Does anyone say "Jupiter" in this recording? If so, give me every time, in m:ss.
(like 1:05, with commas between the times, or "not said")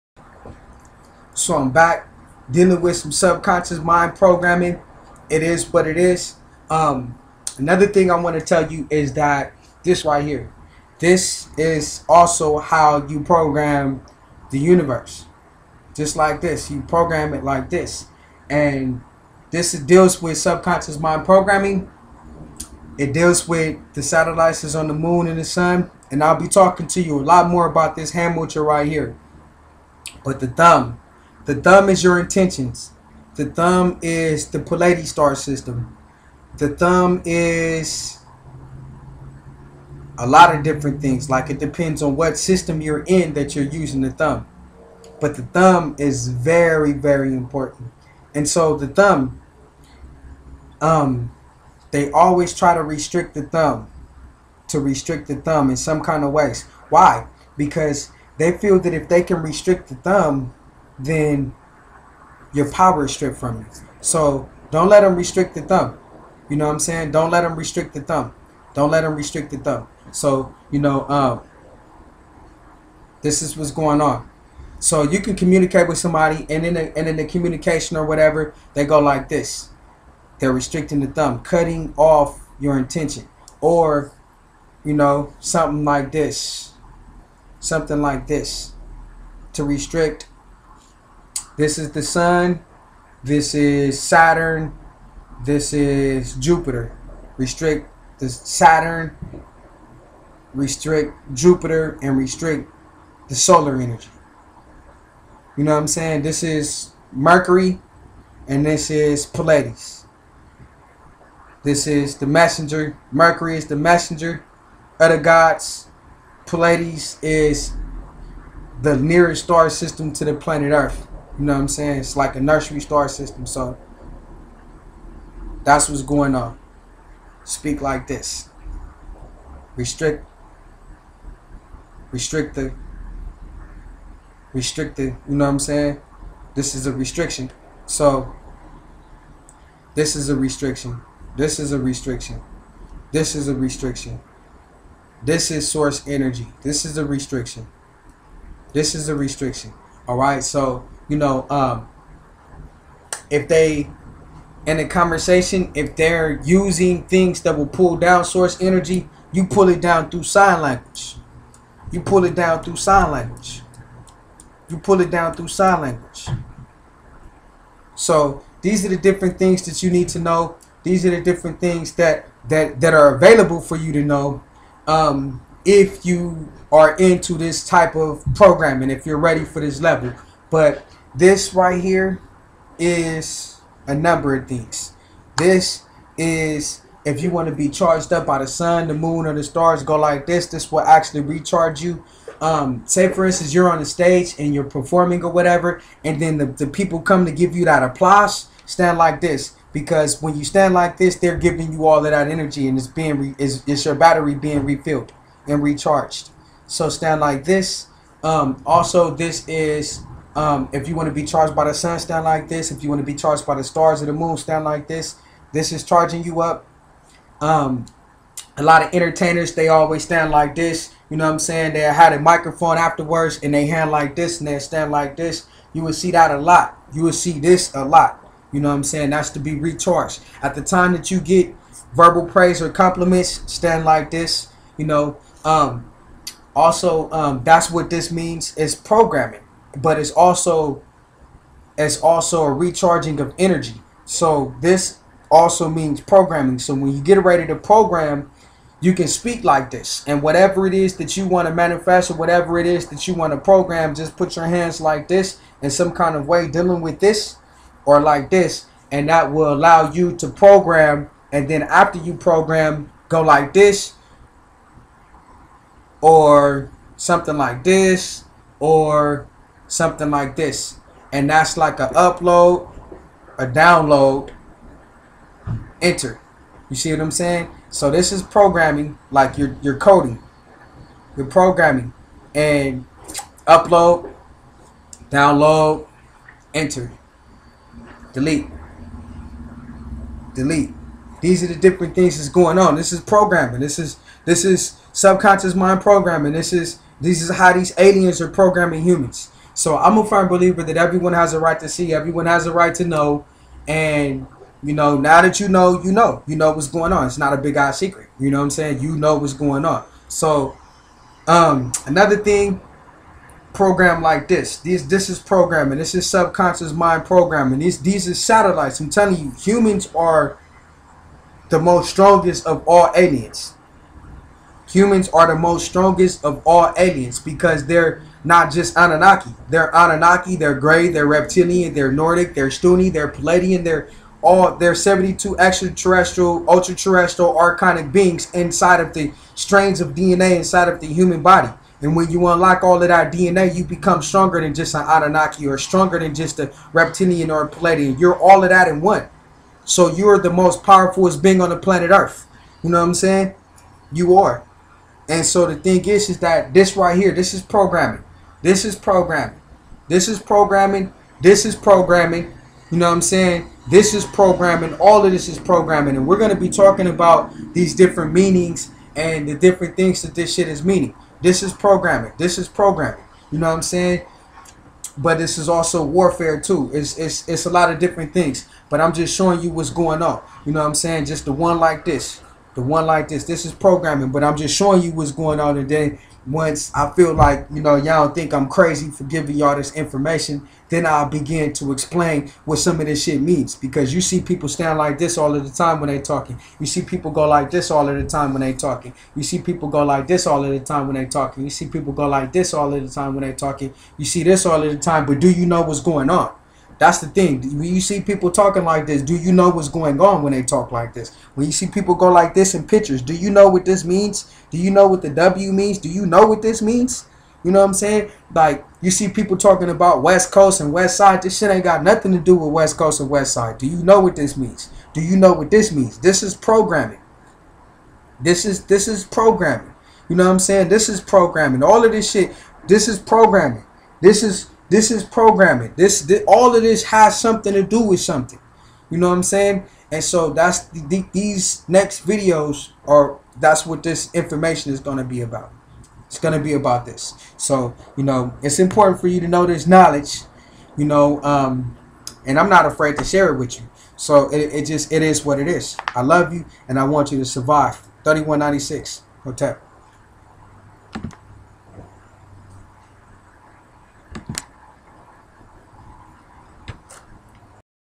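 1:36, 1:41.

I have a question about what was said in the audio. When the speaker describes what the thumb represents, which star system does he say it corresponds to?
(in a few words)
Palladi star system.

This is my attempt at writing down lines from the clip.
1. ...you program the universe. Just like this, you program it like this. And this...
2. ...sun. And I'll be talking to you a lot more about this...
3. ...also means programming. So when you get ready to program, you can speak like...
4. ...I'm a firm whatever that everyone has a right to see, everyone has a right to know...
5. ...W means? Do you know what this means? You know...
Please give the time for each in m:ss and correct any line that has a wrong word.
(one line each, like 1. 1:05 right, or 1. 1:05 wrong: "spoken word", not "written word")
1. 0:13 right
2. 0:25 right
3. 4:05 right
4. 4:59 wrong: "believer", not "whatever"
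5. 6:55 right.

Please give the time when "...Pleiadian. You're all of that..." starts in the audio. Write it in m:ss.
5:47.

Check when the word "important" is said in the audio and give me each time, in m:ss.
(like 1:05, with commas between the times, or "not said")
0:47, 7:28.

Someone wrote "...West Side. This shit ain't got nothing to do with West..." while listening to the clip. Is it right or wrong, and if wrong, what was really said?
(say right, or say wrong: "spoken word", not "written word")
right.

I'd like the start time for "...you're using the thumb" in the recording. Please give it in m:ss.
0:43.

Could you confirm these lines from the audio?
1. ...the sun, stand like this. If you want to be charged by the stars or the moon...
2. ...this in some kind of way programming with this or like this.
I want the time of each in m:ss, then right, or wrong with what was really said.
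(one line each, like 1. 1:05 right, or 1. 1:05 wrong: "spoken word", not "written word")
1. 3:31 right
2. 4:15 wrong: "dealing", not "programming".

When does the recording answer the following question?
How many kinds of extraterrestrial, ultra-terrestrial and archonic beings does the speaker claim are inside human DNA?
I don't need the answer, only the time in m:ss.
5:34.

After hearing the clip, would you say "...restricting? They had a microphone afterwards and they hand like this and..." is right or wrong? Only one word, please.
wrong.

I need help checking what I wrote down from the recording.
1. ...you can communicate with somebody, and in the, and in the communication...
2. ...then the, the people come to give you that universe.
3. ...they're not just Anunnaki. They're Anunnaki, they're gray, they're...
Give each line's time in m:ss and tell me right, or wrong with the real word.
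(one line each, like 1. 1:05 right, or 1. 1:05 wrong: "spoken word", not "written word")
1. 1:15 right
2. 3:16 wrong: "applause", not "universe"
3. 5:27 right.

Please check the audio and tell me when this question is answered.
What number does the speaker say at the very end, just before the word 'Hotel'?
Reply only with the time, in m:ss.
7:38.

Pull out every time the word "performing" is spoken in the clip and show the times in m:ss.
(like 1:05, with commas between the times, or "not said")
3:14.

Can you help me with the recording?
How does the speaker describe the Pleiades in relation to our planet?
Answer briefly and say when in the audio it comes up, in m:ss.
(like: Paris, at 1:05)
Nearest star system, at 1:58.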